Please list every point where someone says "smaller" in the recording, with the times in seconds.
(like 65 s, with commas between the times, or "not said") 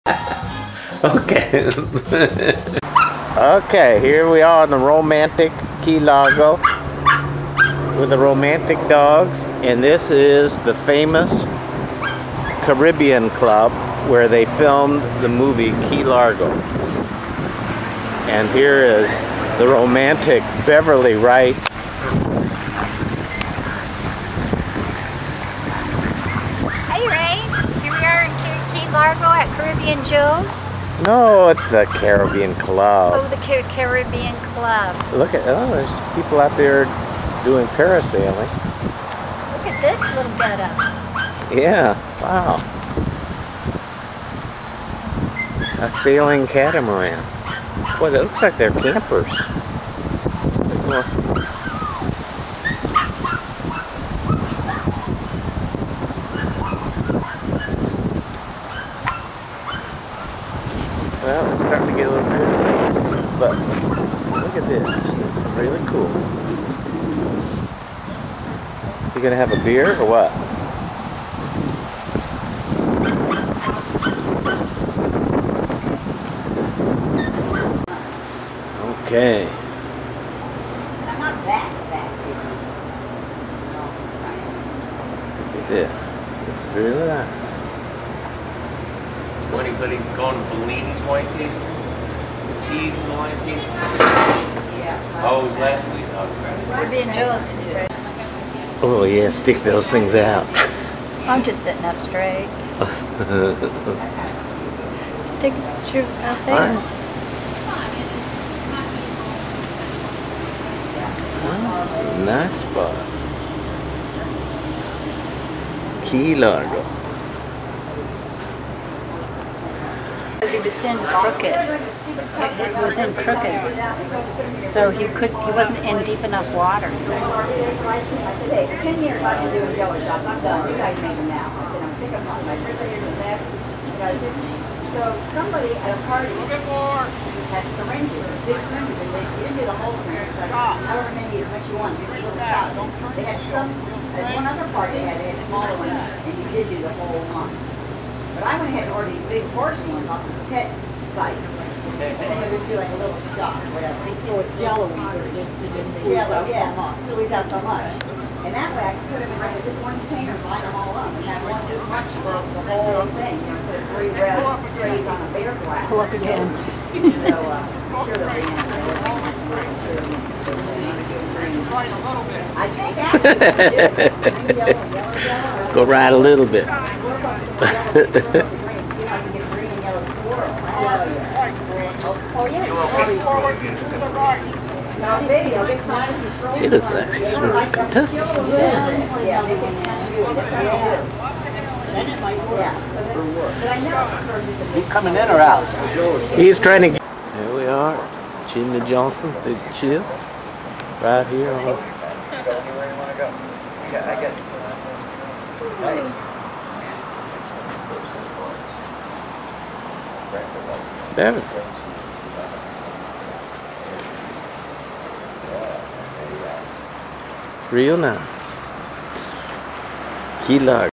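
145 s.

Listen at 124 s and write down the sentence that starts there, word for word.
So he could he wasn't in deep enough water.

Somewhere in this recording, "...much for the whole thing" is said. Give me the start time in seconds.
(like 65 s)
161 s.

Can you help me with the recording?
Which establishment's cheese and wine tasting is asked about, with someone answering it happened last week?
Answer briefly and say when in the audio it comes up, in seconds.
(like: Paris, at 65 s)
Bellini's, at 90 s.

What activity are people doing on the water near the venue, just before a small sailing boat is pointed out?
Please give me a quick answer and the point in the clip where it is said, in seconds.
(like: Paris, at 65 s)
Parasailing, at 37 s.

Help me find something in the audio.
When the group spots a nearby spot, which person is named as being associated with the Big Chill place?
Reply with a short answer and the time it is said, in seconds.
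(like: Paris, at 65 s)
Jimmy Johnson, at 198 s.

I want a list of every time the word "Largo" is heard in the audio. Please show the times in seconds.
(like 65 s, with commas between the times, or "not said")
5 s, 16 s, 28 s, 116 s.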